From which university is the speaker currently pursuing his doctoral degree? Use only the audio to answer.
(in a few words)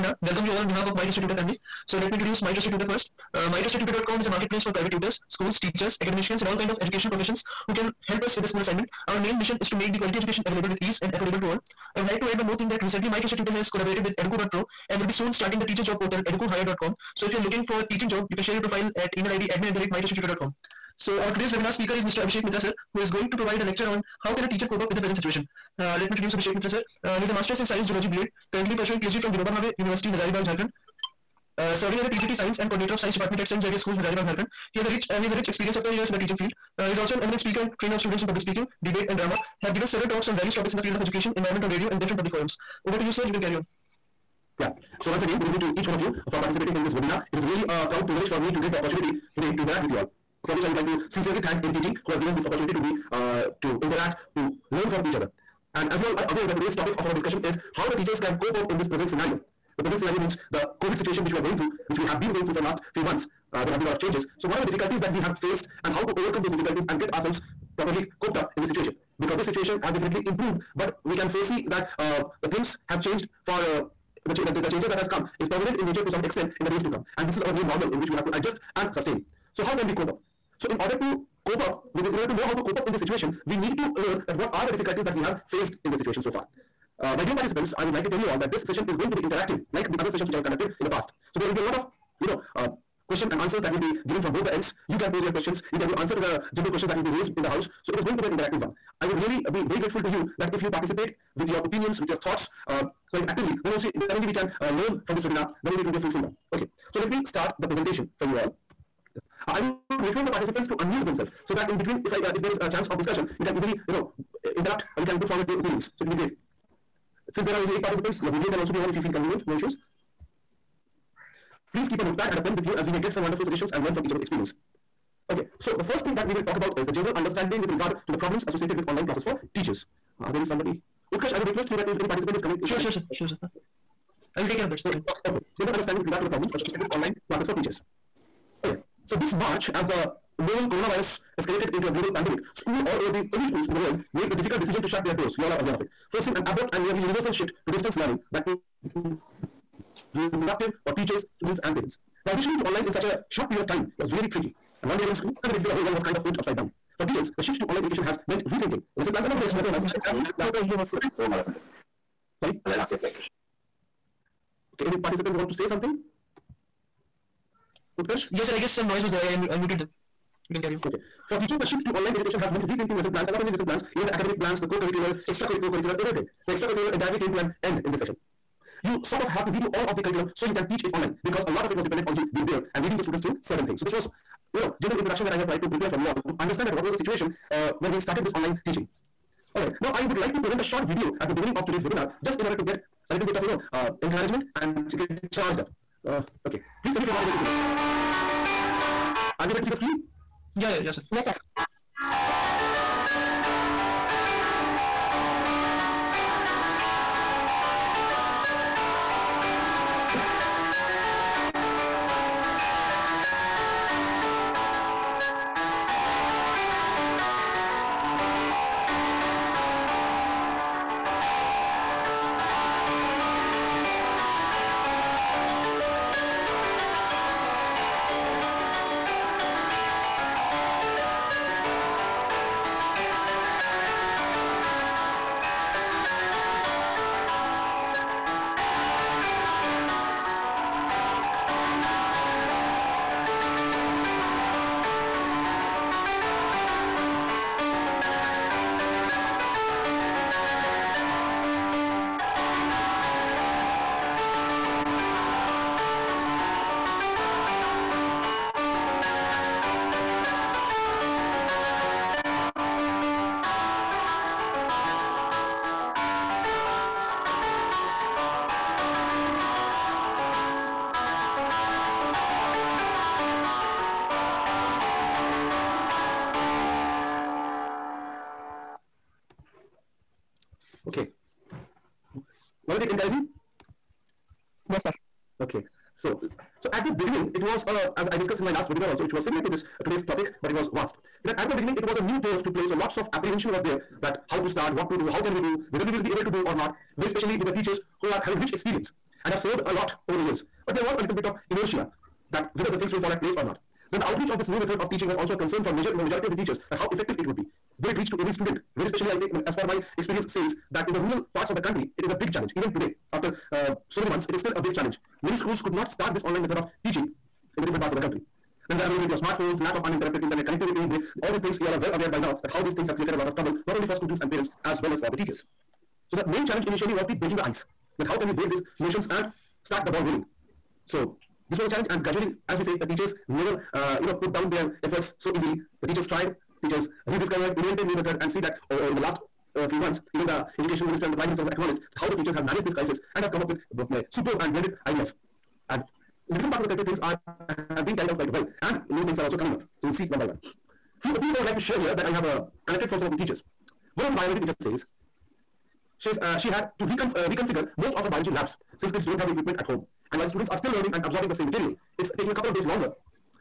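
Vinoba Bhave University.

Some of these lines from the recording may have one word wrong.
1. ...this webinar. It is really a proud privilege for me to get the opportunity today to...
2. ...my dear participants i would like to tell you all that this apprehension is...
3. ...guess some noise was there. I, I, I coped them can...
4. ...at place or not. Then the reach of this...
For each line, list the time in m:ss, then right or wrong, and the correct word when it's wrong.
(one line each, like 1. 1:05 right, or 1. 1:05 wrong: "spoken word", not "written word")
1. 0:46 right
2. 1:27 wrong: "session", not "apprehension"
3. 2:48 wrong: "muted", not "coped"
4. 5:03 wrong: "outreach", not "reach".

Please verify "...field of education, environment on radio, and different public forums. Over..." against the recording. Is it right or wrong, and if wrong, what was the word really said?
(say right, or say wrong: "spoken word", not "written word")
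right.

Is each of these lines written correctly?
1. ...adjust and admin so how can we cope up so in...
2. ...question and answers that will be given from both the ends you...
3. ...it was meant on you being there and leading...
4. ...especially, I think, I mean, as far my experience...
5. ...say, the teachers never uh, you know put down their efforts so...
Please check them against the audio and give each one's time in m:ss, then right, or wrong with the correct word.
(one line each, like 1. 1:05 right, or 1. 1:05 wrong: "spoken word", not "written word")
1. 1:18 wrong: "sustain", not "admin"
2. 1:33 right
3. 3:01 wrong: "dependent", not "meant"
4. 5:08 right
5. 5:32 right.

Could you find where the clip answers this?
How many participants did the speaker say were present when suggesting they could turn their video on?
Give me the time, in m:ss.
1:57.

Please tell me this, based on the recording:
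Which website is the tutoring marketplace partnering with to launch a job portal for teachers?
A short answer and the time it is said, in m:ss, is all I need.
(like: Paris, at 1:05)
educo.pro, at 0:14.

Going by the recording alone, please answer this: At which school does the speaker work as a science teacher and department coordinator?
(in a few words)
St. Xavier School.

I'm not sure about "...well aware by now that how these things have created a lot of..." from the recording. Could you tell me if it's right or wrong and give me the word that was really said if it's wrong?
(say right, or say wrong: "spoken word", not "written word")
right.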